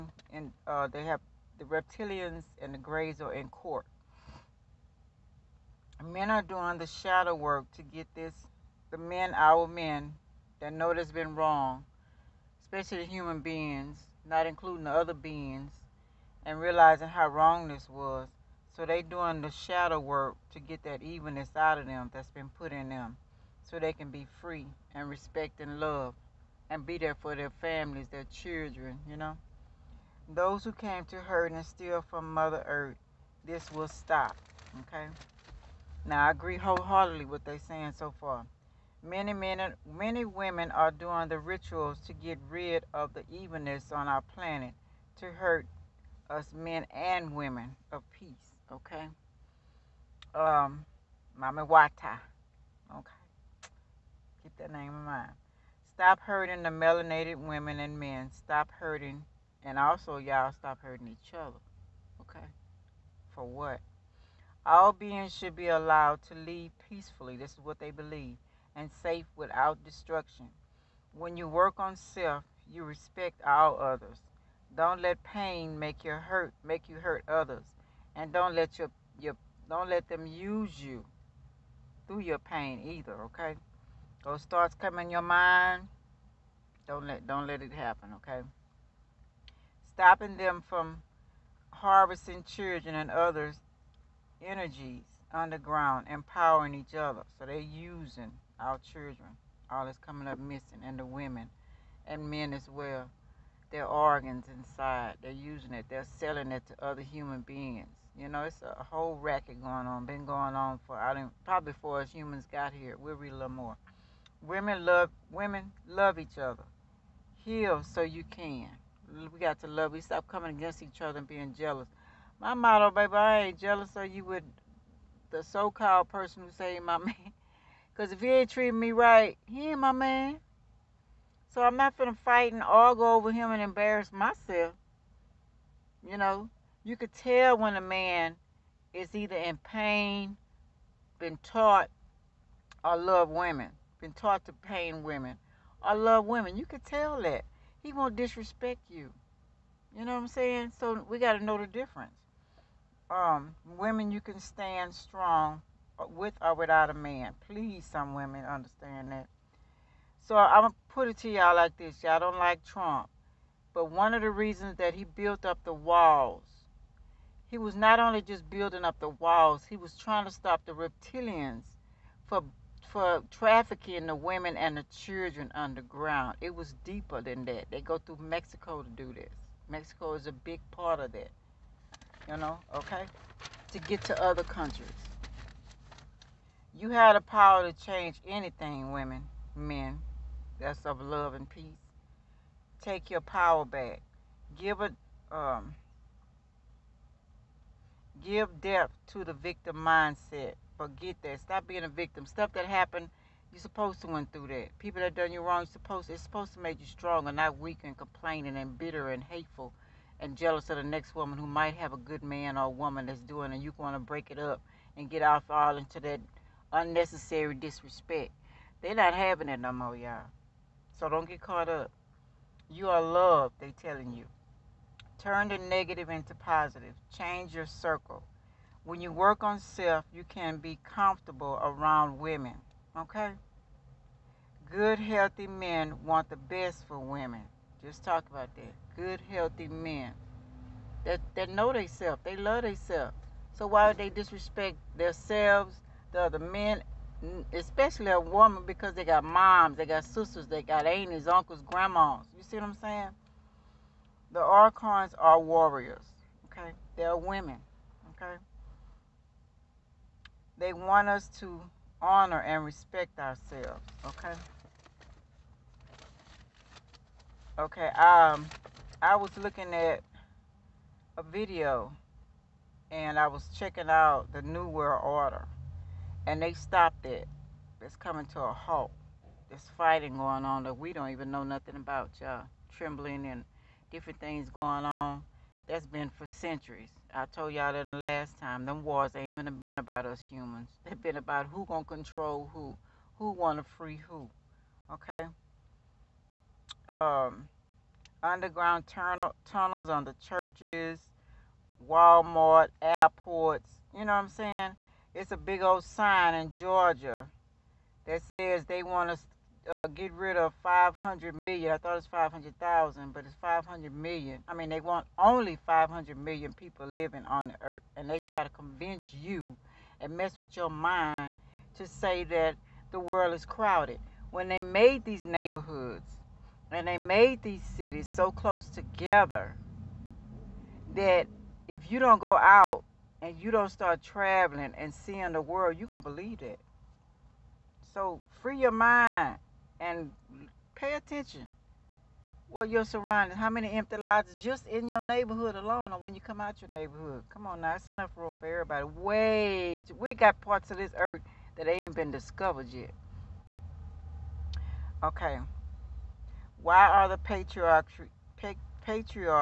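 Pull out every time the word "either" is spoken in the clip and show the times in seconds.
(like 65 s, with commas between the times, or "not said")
82 s, 139 s.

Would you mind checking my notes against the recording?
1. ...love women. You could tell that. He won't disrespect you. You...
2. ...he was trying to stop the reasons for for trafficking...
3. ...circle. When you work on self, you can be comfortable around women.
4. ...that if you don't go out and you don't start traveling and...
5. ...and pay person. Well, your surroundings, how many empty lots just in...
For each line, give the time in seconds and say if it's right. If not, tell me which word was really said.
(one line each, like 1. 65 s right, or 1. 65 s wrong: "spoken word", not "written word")
1. 145 s right
2. 169 s wrong: "reptilians", not "reasons"
3. 227 s right
4. 330 s right
5. 339 s wrong: "attention", not "person".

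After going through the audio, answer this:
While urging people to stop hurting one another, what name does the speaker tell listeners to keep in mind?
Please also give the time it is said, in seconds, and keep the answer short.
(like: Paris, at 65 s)
Mama Wata, at 51 s.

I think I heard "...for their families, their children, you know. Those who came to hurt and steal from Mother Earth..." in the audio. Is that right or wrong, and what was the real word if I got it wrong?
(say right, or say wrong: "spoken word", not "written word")
right.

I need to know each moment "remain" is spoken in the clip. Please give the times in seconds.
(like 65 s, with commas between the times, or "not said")
not said.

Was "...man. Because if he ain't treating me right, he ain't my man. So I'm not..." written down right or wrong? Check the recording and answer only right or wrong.
right.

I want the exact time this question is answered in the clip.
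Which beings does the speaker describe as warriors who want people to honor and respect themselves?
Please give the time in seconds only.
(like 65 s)
254 s.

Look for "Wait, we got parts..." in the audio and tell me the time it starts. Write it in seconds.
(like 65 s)
348 s.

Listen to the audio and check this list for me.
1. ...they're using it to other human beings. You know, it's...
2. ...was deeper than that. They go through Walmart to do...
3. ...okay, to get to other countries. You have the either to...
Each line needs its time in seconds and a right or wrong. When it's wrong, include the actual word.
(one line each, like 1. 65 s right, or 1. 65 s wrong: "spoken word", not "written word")
1. 105 s wrong: "selling", not "using"
2. 176 s wrong: "Mexico", not "Walmart"
3. 182 s wrong: "power", not "either".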